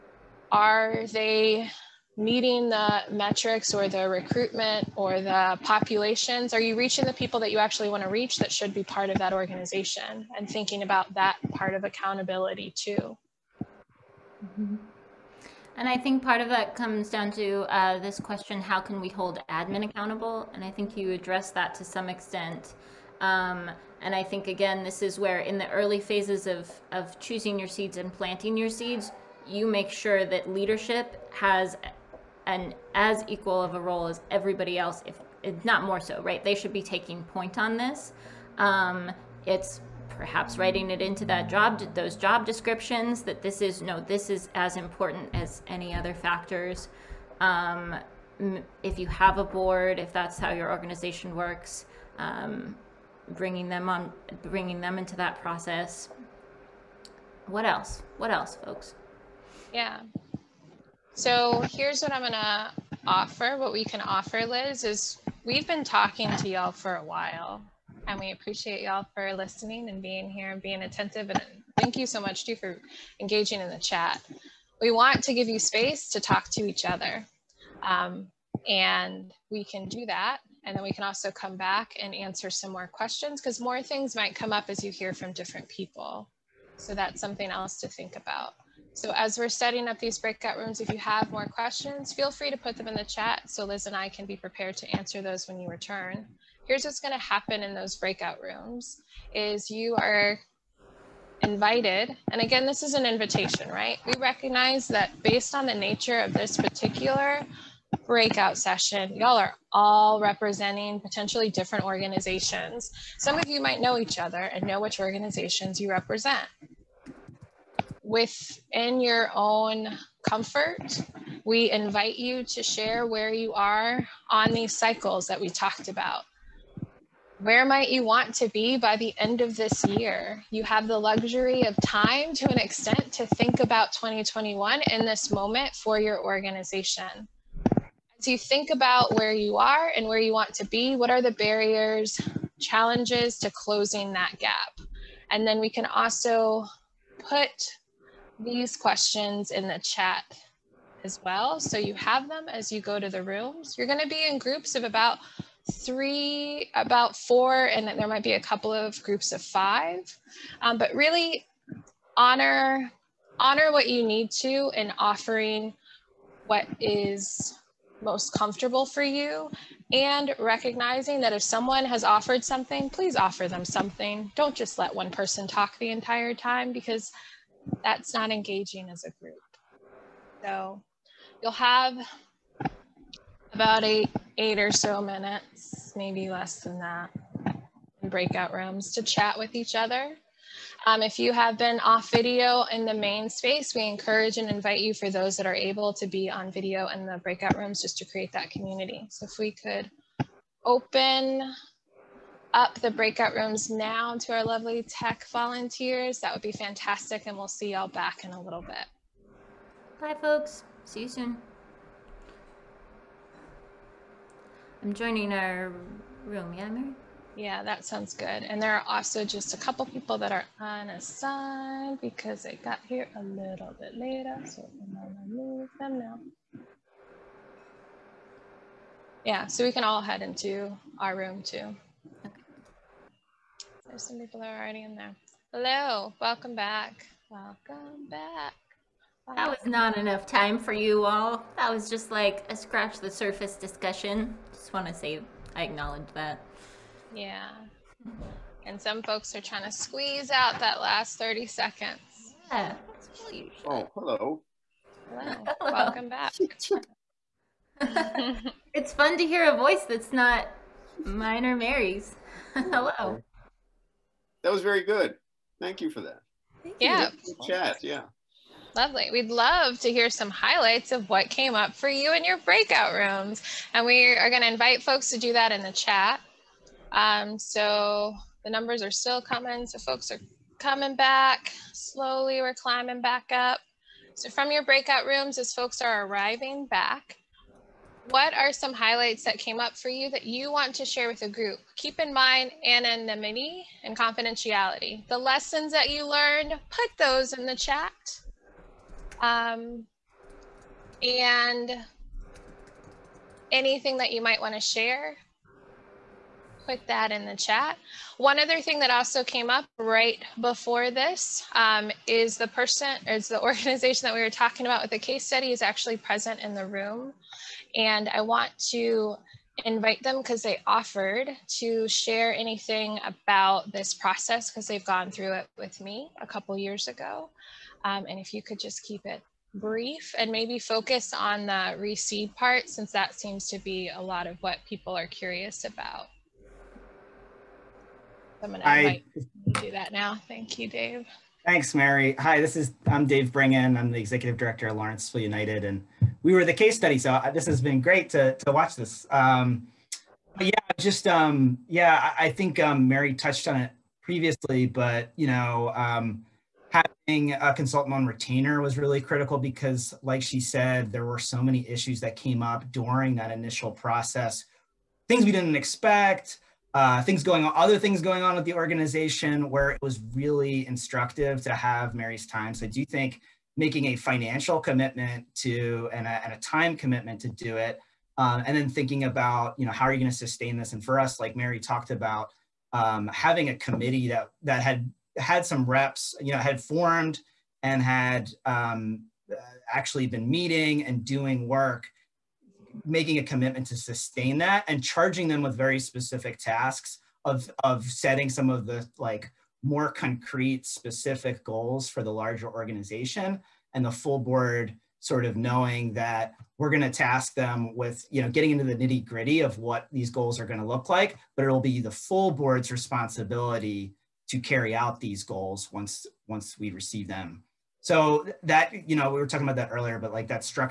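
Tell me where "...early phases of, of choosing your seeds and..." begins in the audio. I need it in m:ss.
0:25.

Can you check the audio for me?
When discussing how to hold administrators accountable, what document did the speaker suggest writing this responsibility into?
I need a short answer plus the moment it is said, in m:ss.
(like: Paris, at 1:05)
job descriptions, at 0:42.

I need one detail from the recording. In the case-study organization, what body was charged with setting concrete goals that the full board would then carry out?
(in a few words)
a committee.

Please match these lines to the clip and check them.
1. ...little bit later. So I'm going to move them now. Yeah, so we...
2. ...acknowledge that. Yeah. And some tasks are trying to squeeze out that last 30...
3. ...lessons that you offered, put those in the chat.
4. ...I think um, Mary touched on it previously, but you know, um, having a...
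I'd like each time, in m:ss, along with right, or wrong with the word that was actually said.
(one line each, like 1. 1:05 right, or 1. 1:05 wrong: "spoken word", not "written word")
1. 3:43 right
2. 4:05 wrong: "folks", not "tasks"
3. 4:55 wrong: "learned", not "offered"
4. 5:52 right.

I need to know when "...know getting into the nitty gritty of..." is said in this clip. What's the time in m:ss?
6:48.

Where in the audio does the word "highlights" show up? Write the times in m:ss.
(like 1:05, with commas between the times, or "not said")
4:30, 4:48.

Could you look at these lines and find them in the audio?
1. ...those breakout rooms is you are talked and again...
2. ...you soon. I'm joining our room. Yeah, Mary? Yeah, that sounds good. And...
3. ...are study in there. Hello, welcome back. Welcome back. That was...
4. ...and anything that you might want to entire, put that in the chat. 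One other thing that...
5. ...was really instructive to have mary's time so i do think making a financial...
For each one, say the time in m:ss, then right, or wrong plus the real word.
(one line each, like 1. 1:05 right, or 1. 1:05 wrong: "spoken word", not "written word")
1. 1:37 wrong: "invited", not "talked"
2. 3:31 right
3. 3:54 wrong: "already", not "study"
4. 5:01 wrong: "share", not "entire"
5. 6:09 right.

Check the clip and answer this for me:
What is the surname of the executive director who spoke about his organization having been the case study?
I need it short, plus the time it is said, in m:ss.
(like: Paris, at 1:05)
Breingan, at 5:43.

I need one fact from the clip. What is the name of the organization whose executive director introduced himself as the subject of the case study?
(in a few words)
Lawrenceville United.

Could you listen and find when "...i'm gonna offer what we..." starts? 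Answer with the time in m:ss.
1:02.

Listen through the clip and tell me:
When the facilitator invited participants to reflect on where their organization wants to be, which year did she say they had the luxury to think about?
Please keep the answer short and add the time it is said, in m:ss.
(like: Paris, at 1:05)
2021, at 2:13.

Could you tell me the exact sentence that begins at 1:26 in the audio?
So that's something else to think about.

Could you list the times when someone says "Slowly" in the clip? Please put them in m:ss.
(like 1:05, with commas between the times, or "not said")
4:41.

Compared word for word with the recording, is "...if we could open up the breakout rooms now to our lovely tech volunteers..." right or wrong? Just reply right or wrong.
right.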